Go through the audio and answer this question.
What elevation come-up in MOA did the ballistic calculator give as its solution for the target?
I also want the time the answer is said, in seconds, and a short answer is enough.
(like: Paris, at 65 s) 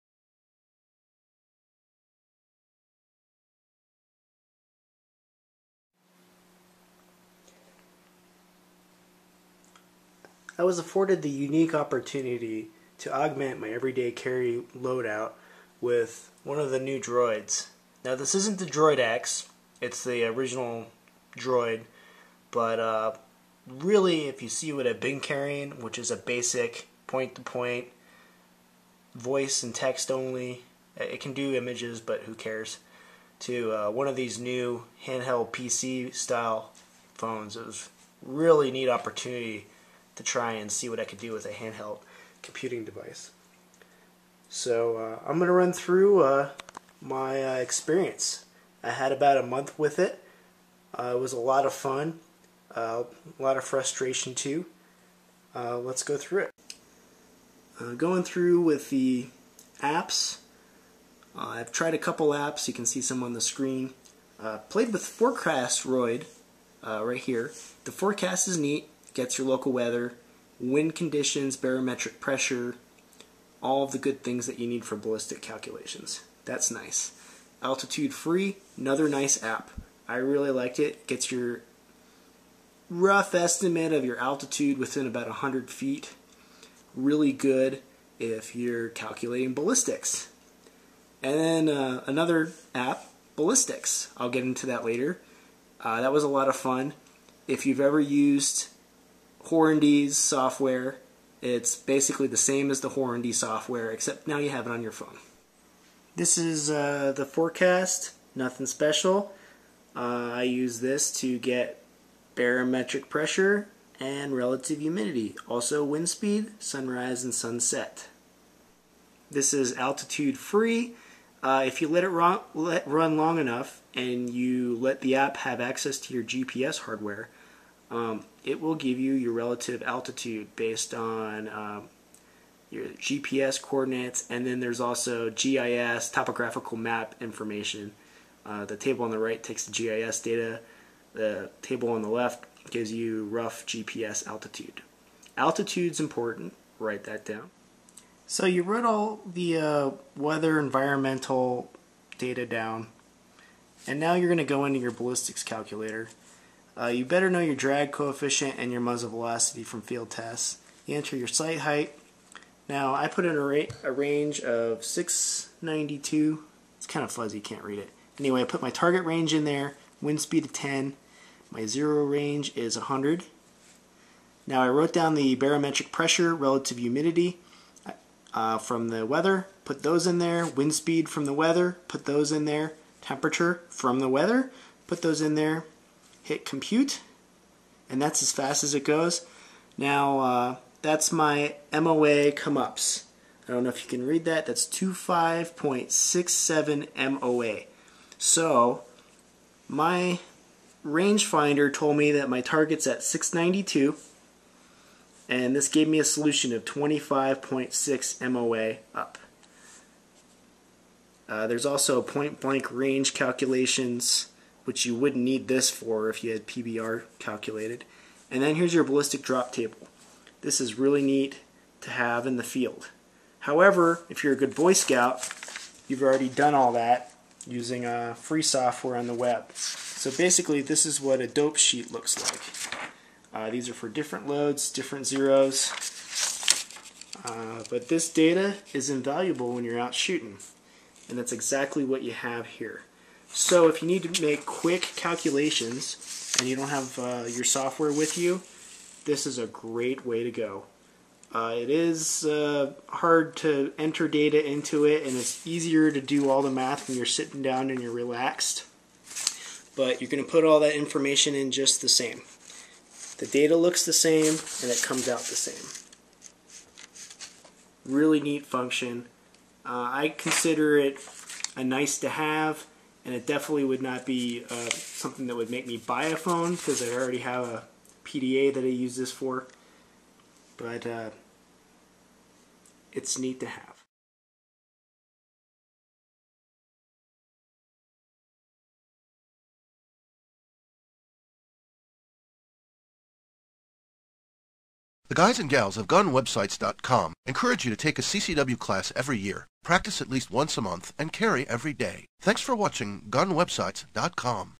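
25.67 MOA, at 194 s.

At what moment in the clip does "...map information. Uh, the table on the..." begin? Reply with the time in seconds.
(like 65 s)
136 s.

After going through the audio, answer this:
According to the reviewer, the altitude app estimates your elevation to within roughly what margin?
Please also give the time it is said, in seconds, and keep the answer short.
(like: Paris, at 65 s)
100 feet, at 85 s.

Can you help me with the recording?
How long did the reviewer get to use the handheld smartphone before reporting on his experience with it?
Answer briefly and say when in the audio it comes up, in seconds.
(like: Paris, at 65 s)
about a month, at 49 s.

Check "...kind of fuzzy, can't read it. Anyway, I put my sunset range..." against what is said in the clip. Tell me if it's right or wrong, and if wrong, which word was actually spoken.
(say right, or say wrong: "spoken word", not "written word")
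wrong: "target", not "sunset".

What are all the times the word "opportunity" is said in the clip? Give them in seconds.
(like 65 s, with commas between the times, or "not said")
11 s, 38 s.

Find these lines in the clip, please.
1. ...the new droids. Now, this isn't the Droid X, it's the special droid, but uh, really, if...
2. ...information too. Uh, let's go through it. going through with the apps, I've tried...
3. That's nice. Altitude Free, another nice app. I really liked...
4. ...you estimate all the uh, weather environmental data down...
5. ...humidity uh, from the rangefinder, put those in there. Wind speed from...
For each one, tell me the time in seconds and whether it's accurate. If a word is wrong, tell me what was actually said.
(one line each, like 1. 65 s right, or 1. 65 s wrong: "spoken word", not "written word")
1. 16 s wrong: "original", not "special"
2. 53 s wrong: "frustration", not "information"
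3. 76 s right
4. 148 s wrong: "wrote", not "estimate"
5. 176 s wrong: "weather", not "rangefinder".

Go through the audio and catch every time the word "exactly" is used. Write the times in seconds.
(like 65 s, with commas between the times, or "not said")
241 s.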